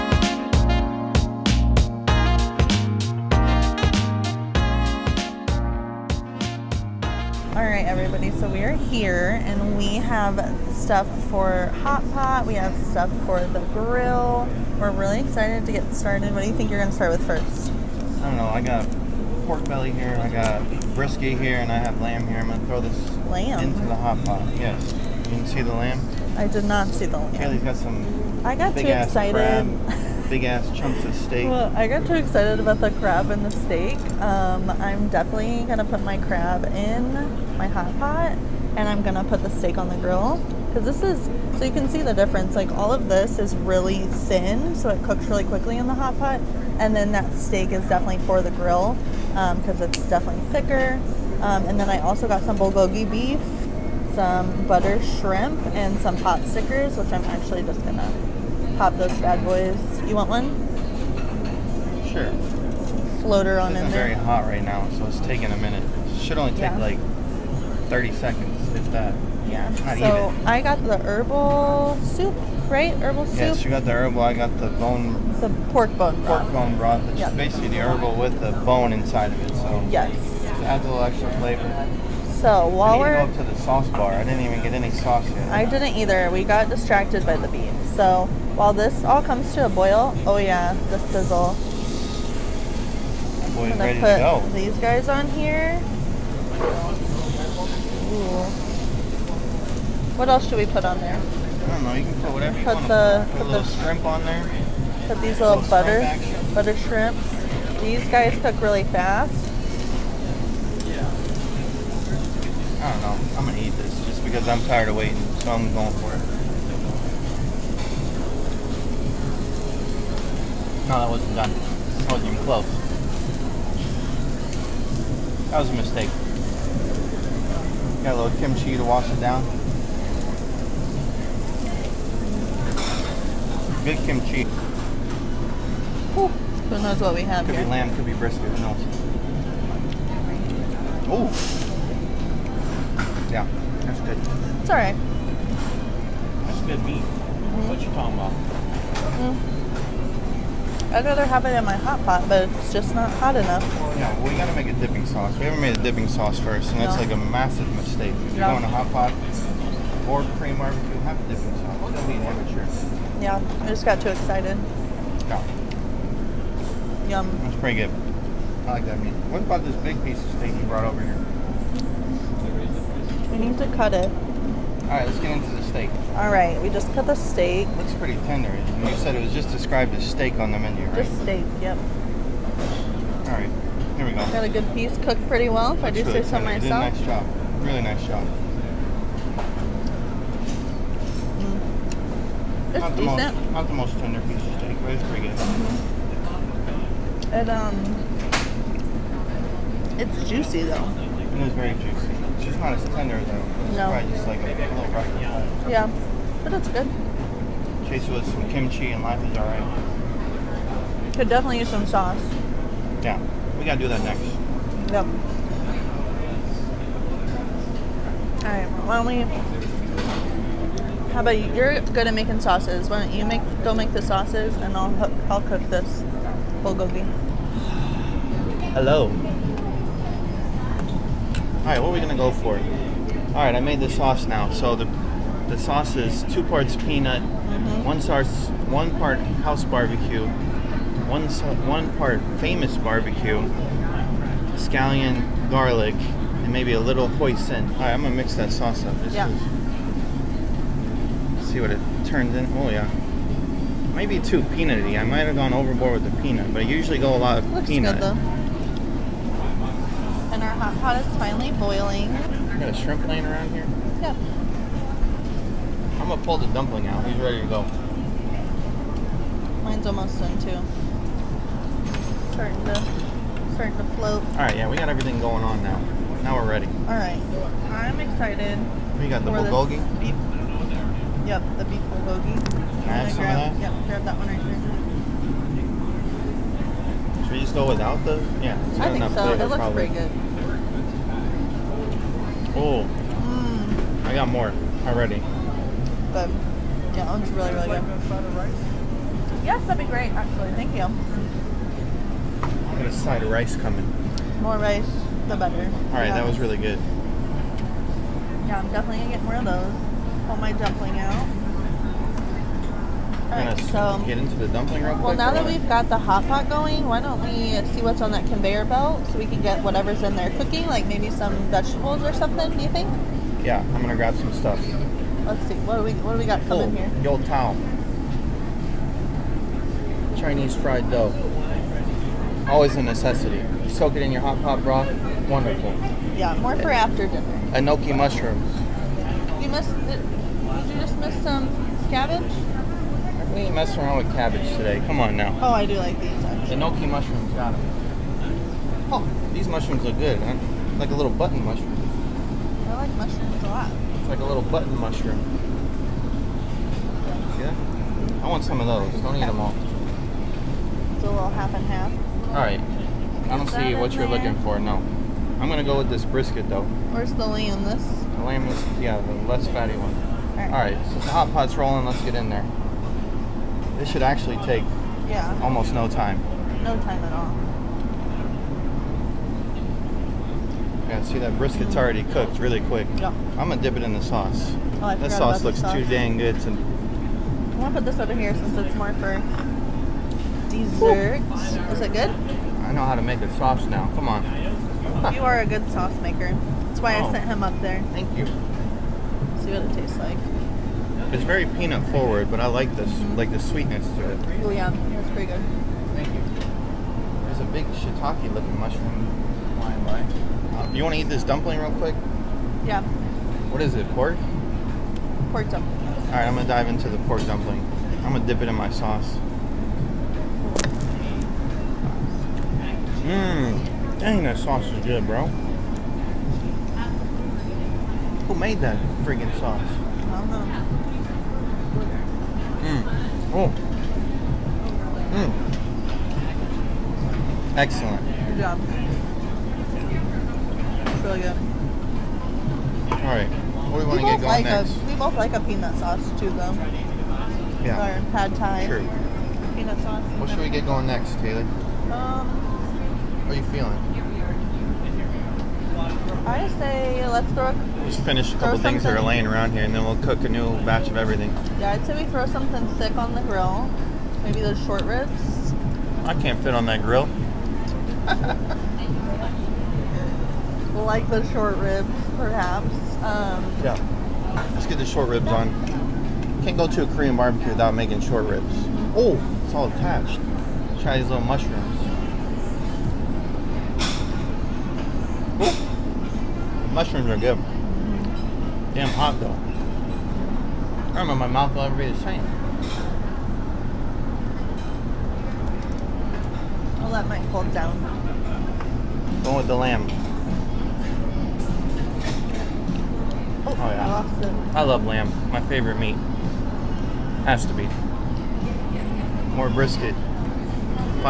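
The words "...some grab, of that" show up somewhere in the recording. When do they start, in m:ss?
4:43.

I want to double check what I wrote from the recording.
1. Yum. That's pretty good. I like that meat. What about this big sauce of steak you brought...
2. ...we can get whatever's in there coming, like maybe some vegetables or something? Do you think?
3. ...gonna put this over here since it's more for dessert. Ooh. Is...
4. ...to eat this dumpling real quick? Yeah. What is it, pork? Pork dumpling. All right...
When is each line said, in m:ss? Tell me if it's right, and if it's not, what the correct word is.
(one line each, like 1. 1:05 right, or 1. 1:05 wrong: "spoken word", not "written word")
1. 2:47 wrong: "piece", not "sauce"
2. 5:19 wrong: "cooking", not "coming"
3. 6:27 right
4. 6:50 right.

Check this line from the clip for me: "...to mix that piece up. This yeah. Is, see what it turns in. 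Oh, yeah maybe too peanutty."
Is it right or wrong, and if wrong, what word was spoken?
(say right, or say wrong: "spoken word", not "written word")
wrong: "sauce", not "piece".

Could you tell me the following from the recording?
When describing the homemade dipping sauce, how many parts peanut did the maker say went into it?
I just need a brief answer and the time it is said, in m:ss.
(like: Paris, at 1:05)
2, at 3:56.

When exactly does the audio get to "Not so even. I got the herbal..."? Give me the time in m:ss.
1:09.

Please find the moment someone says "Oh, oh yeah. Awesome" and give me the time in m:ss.
8:23.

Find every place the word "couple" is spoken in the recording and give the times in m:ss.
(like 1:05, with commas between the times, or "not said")
7:38.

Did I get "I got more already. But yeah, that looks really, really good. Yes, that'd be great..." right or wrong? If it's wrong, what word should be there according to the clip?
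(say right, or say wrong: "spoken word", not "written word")
right.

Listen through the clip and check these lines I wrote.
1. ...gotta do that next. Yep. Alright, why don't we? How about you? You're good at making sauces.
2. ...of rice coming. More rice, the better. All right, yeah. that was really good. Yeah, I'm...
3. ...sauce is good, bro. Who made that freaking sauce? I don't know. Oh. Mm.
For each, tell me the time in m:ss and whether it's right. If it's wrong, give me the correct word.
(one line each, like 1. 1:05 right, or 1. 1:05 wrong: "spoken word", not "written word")
1. 3:33 right
2. 5:03 right
3. 7:04 right.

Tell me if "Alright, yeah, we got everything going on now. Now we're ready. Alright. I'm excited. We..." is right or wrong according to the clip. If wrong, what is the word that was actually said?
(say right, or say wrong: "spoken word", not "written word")
right.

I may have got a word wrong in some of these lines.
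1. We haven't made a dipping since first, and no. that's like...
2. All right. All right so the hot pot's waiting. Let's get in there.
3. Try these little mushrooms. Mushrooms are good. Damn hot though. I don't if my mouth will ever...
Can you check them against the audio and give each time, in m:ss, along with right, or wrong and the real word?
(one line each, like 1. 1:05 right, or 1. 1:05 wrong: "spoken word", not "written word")
1. 2:35 wrong: "sauce", not "since"
2. 6:09 wrong: "rolling", not "waiting"
3. 8:00 right.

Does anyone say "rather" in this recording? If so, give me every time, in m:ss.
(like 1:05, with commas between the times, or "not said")
2:31.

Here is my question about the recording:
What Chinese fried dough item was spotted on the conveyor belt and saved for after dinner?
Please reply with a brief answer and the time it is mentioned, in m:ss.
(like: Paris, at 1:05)
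Yo Tao, at 5:27.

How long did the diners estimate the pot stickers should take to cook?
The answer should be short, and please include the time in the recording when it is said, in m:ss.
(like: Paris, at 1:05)
30 seconds, at 1:06.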